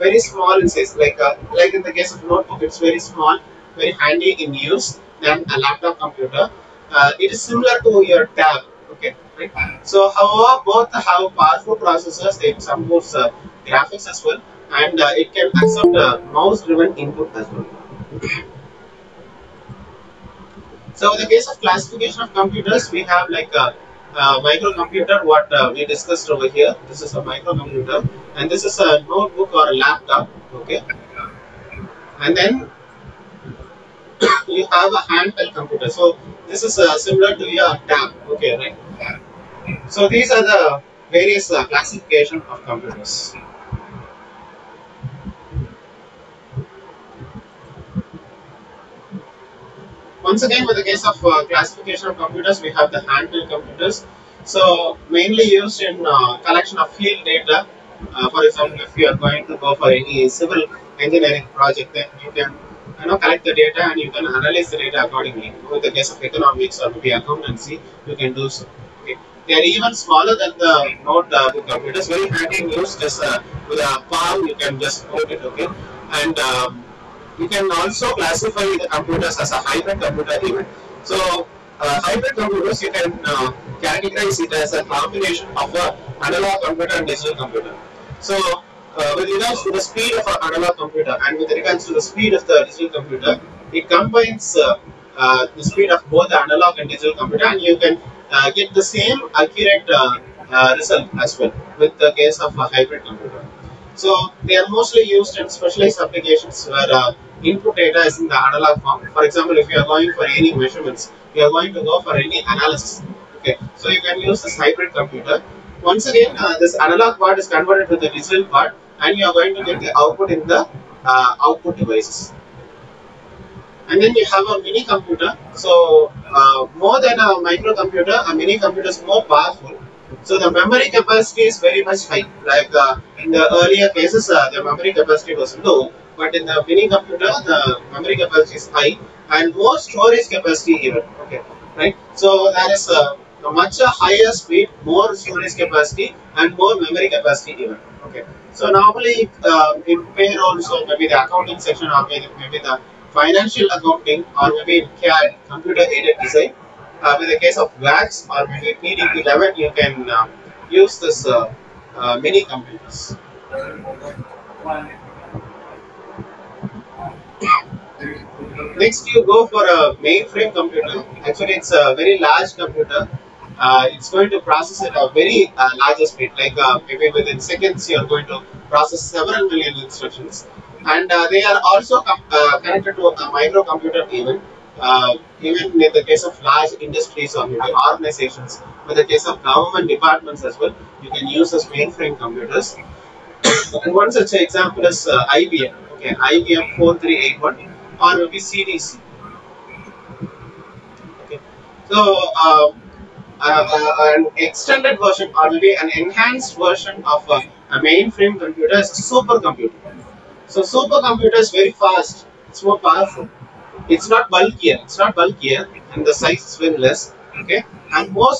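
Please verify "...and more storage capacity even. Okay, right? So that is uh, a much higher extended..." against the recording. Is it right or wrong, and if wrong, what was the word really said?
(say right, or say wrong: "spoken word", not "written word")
wrong: "speed", not "extended".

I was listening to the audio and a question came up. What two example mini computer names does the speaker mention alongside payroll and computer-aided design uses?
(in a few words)
VAX or PDP-11.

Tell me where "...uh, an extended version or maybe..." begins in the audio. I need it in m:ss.
3:23.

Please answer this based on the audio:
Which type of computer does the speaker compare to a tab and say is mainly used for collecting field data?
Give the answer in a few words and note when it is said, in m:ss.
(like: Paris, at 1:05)
Handheld computer, at 0:35.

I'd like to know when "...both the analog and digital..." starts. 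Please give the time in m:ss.
1:36.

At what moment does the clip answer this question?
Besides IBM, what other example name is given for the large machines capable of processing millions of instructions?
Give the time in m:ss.
3:18.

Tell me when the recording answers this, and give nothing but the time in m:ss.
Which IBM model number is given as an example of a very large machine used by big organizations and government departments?
3:16.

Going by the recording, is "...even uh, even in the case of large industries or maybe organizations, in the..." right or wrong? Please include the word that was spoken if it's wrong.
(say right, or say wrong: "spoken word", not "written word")
right.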